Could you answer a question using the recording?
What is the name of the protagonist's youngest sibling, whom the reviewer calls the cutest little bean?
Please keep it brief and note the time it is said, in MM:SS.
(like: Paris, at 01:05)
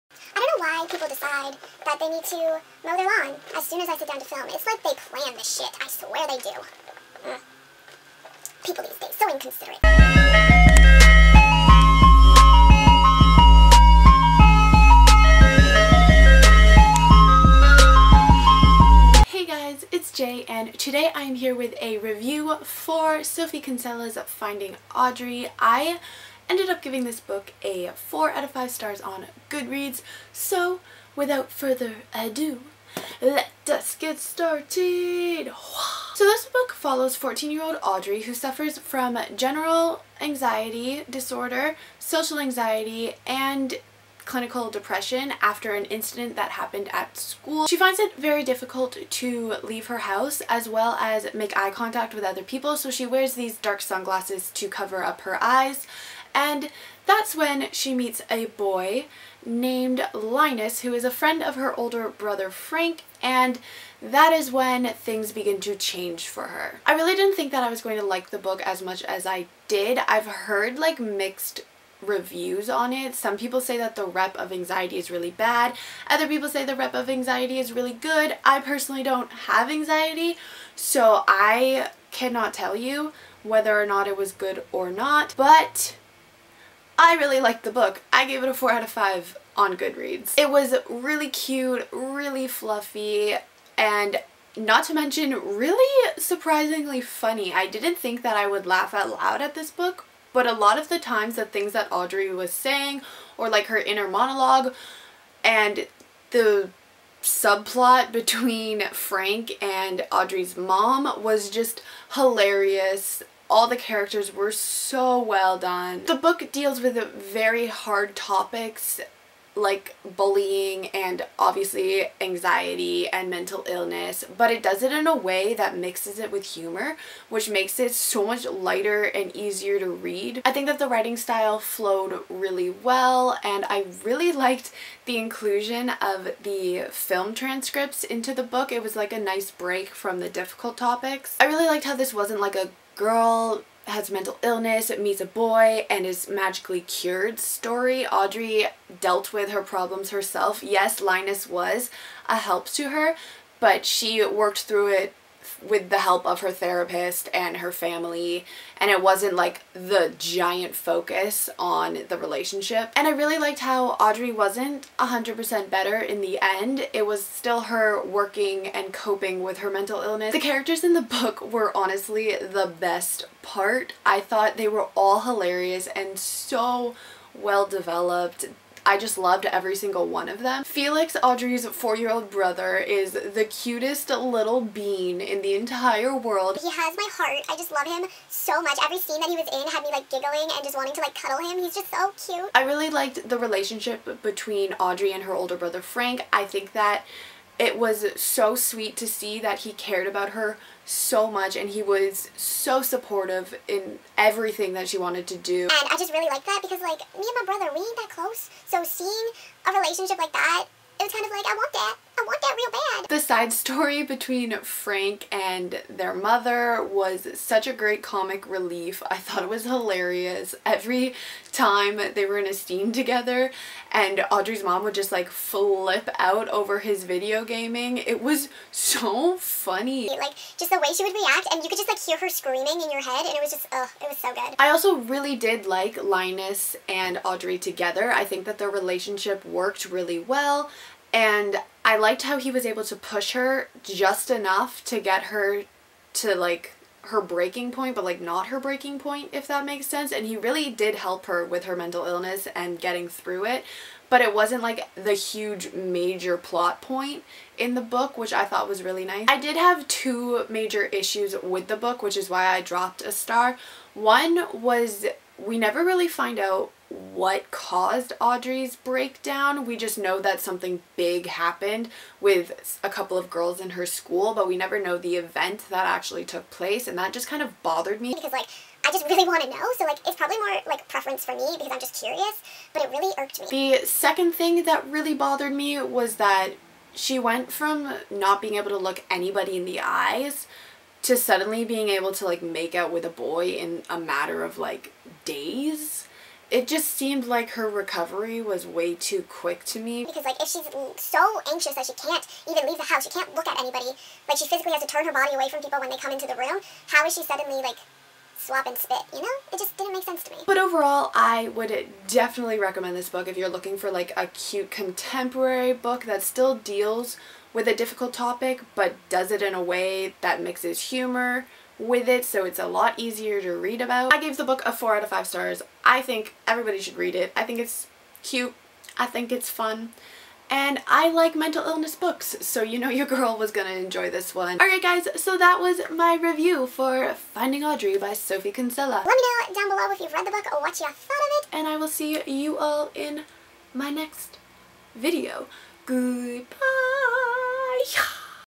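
Felix, at 03:00.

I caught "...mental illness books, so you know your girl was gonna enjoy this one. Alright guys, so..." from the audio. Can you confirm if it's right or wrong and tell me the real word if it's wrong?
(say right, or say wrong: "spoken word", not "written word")
right.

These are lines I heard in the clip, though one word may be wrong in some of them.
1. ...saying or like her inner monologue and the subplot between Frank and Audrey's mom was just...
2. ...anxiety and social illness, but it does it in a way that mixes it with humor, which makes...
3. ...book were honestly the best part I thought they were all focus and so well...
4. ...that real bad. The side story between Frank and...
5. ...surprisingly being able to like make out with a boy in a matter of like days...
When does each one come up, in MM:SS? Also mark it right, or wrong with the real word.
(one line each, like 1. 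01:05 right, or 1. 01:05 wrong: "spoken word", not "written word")
1. 01:42 right
2. 02:02 wrong: "mental", not "social"
3. 02:51 wrong: "hilarious", not "focus"
4. 03:32 right
5. 04:51 wrong: "suddenly", not "surprisingly".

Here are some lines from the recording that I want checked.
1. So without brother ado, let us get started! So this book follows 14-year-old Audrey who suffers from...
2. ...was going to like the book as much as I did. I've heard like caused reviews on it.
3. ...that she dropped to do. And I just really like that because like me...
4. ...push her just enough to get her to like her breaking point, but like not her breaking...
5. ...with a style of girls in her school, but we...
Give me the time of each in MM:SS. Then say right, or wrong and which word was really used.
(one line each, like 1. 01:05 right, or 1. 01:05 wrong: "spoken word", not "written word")
1. 00:30 wrong: "further", not "brother"
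2. 01:07 wrong: "mixed", not "caused"
3. 03:24 wrong: "wanted", not "dropped"
4. 04:02 right
5. 04:32 wrong: "couple", not "style".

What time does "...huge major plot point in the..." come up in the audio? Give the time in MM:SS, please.
04:15.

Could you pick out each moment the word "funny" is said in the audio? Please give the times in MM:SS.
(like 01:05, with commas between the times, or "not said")
01:37, 03:49.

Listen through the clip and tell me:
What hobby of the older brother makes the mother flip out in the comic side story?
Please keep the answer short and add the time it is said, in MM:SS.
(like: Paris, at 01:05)
Video gaming, at 03:47.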